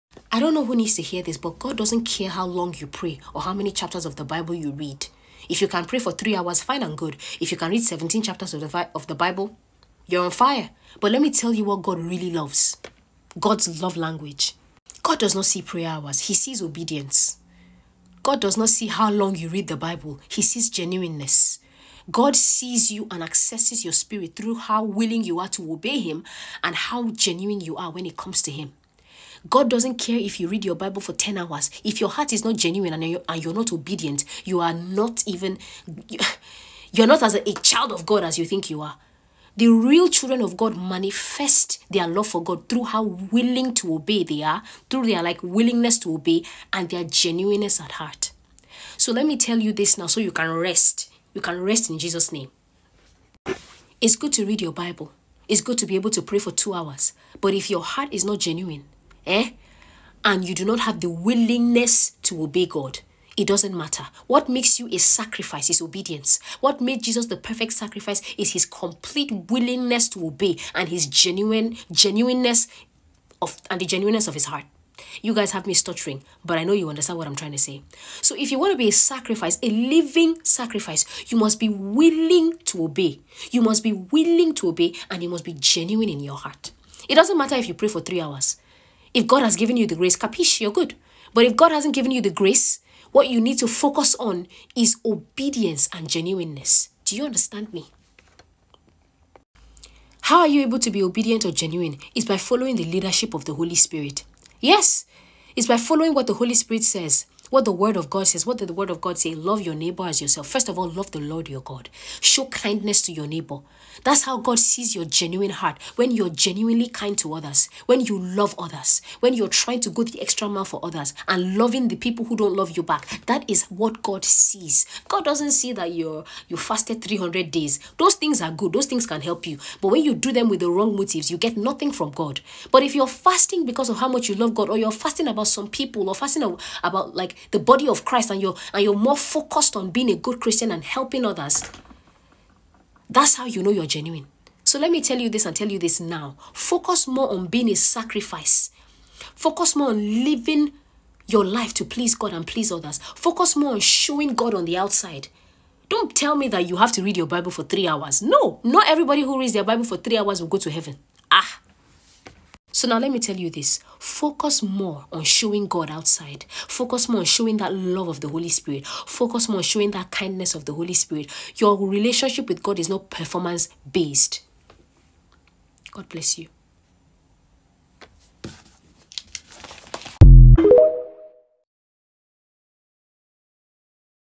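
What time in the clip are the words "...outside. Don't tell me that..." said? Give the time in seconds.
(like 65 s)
154 s.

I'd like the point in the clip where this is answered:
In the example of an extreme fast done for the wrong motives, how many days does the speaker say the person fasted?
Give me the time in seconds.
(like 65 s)
127 s.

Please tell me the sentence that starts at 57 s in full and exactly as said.
But if your heart is not genuine, eh?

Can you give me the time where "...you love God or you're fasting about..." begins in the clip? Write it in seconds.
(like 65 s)
134 s.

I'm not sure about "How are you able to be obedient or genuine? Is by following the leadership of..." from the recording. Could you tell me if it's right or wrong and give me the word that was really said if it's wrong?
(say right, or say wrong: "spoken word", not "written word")
right.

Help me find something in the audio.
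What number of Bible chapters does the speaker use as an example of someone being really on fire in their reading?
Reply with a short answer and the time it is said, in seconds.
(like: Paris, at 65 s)
17, at 7 s.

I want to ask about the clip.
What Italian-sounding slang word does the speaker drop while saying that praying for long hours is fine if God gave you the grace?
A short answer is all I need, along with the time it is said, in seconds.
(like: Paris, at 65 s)
Capiche, at 90 s.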